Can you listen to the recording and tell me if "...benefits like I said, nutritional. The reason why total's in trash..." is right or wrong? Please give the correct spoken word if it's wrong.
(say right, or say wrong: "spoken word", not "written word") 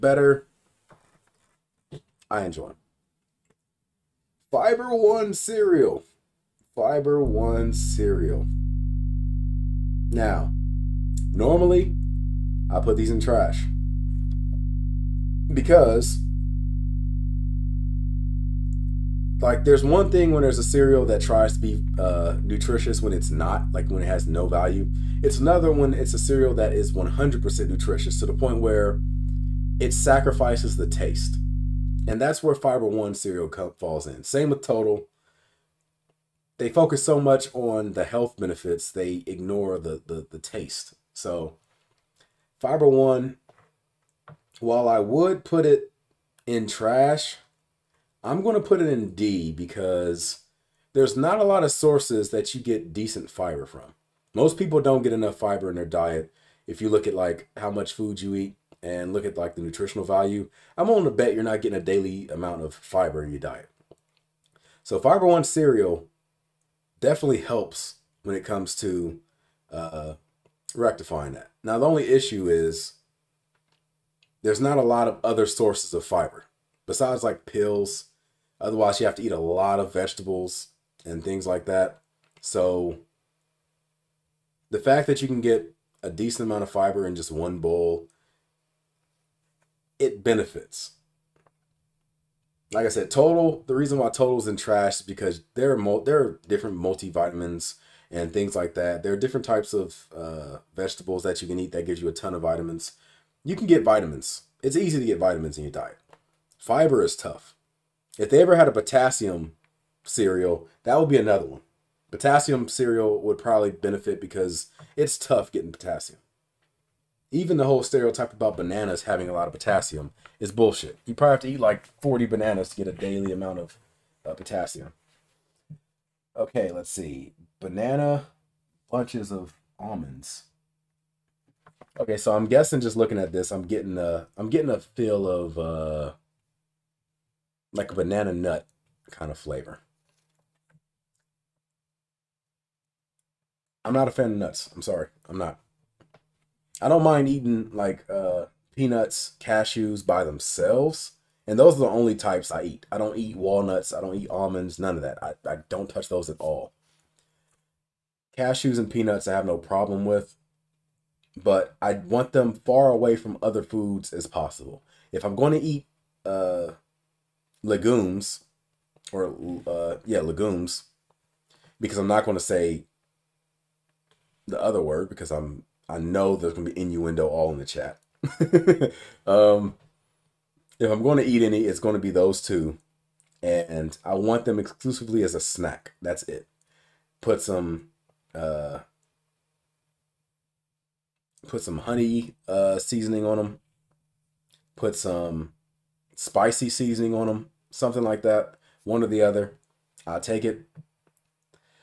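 wrong: "total", not "nutritional".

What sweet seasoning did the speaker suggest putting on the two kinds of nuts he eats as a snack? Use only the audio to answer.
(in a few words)
honey.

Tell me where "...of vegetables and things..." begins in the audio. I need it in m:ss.
1:19.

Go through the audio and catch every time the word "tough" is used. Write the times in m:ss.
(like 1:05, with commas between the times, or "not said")
1:47, 1:55.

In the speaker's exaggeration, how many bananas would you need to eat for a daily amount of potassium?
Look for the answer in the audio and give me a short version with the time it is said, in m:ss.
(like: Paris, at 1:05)
40, at 2:02.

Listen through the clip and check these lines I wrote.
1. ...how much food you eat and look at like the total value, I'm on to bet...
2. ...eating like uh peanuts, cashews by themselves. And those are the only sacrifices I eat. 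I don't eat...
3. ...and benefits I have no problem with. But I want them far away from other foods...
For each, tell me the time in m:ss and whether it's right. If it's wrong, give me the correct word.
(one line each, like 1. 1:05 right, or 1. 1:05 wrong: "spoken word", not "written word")
1. 0:57 wrong: "nutritional", not "total"
2. 2:27 wrong: "types", not "sacrifices"
3. 2:38 wrong: "peanuts", not "benefits".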